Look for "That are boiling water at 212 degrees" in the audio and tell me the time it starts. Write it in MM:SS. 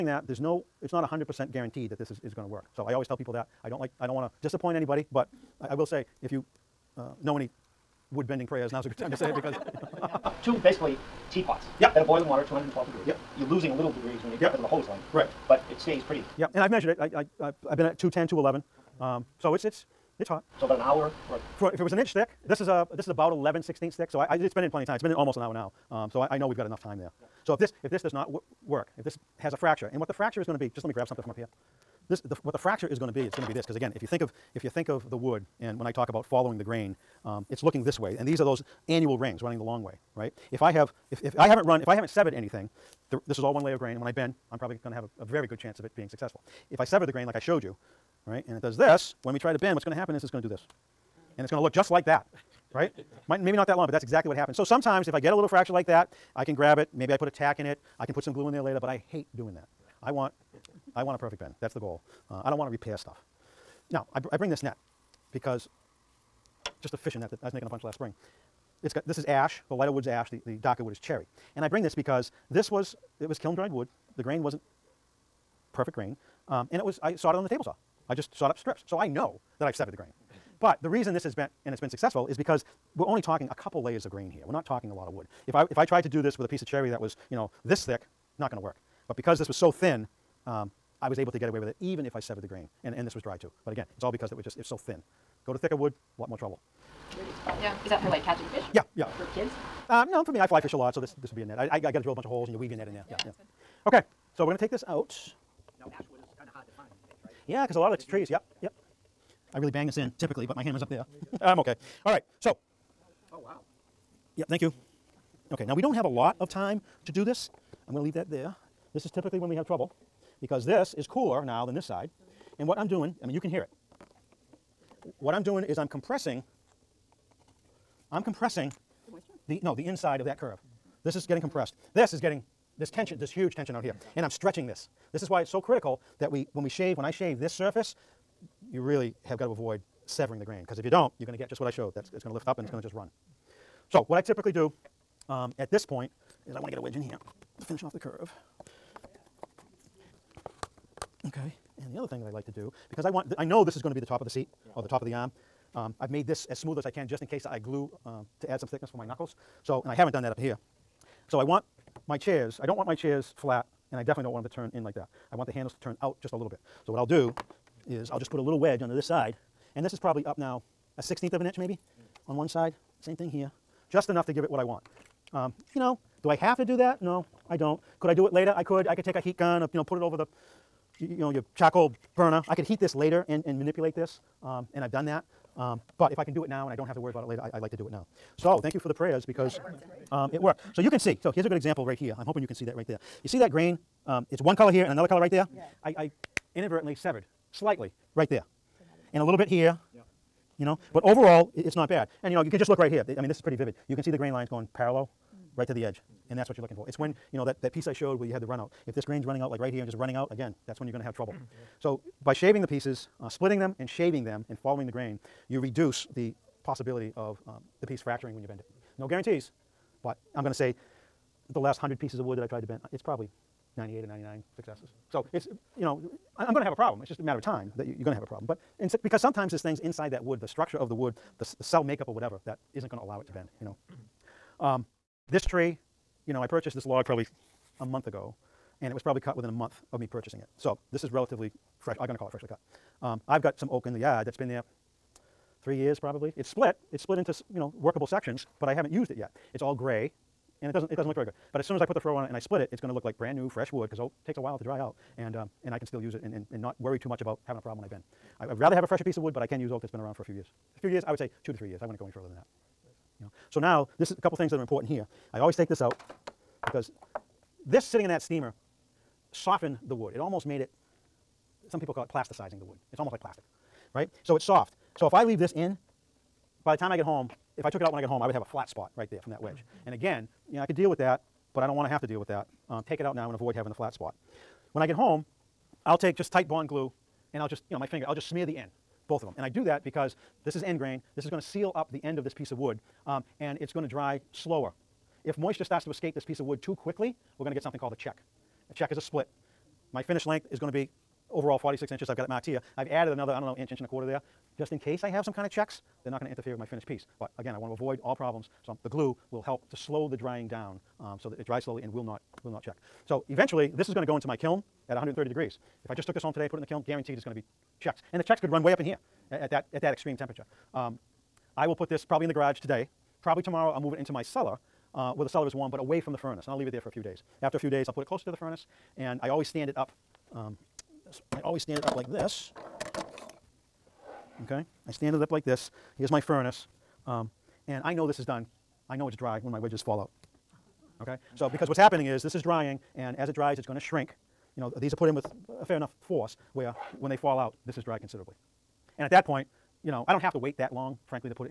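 00:11.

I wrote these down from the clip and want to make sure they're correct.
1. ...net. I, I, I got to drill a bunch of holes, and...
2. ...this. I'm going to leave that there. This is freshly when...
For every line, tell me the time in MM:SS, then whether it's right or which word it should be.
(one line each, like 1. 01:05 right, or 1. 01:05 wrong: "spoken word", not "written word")
1. 01:41 right
2. 01:57 wrong: "typically", not "freshly".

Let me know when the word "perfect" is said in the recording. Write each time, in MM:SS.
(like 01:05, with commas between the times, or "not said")
01:01, 01:15.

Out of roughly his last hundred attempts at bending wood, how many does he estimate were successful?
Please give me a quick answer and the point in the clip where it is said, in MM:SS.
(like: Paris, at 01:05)
98 or 99, at 03:43.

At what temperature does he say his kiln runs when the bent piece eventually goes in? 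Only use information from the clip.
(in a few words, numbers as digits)
130 degrees.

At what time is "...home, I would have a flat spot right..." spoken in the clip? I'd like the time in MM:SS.
04:38.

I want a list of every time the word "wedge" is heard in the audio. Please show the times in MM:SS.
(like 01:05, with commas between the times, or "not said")
02:26, 02:48, 04:39, 05:39.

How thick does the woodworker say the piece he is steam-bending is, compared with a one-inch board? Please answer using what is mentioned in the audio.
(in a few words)
11/16 inch.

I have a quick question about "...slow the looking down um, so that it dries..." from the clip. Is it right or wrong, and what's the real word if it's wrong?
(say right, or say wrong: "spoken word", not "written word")
wrong: "drying", not "looking".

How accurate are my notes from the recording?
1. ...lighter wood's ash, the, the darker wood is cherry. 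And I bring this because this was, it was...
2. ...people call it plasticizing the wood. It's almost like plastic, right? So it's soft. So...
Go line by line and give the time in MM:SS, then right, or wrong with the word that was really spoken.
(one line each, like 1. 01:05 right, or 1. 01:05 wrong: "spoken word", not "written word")
1. 01:09 right
2. 04:31 right.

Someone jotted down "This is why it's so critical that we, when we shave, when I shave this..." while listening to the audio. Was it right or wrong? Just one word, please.
right.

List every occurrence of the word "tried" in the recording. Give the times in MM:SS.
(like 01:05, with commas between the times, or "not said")
01:25, 03:42.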